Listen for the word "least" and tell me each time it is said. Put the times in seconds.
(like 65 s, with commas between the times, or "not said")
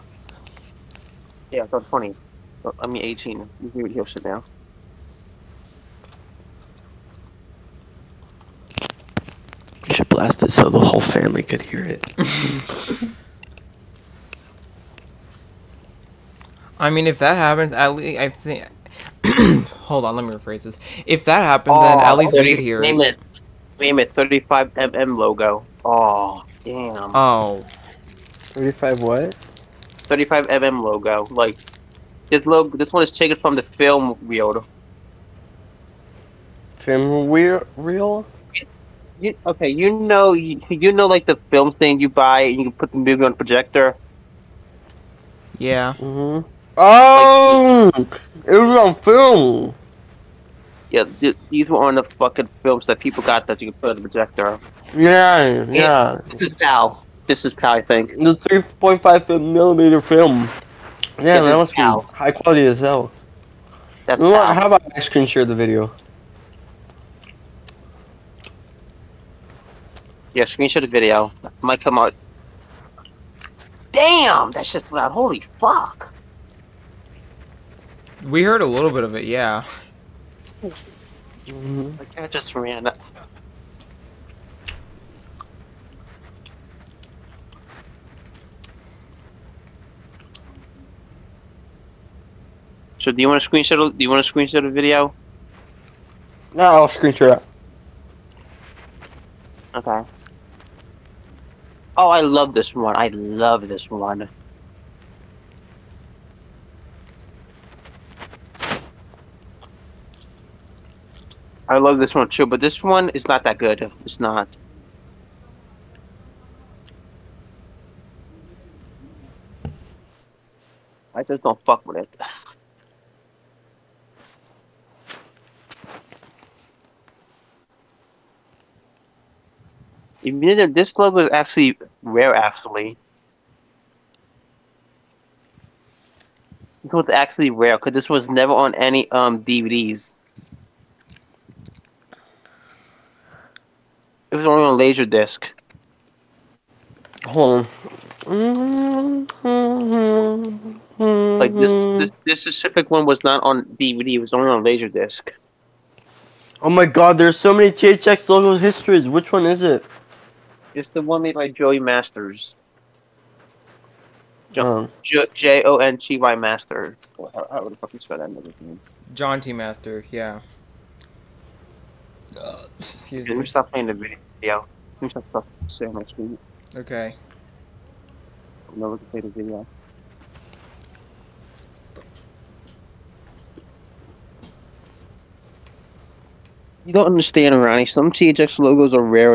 17 s, 22 s.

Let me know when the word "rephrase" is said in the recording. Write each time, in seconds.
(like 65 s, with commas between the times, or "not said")
20 s.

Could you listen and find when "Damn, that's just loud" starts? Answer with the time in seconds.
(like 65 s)
73 s.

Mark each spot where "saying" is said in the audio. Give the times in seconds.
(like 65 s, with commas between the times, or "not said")
175 s.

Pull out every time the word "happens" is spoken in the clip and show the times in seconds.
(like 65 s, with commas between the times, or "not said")
17 s, 21 s.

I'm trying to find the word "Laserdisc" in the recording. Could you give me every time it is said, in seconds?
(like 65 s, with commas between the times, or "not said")
144 s, 154 s.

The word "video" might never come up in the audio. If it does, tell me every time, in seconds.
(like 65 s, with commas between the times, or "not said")
65 s, 70 s, 94 s, 173 s, 179 s.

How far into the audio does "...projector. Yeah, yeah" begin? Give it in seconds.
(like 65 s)
54 s.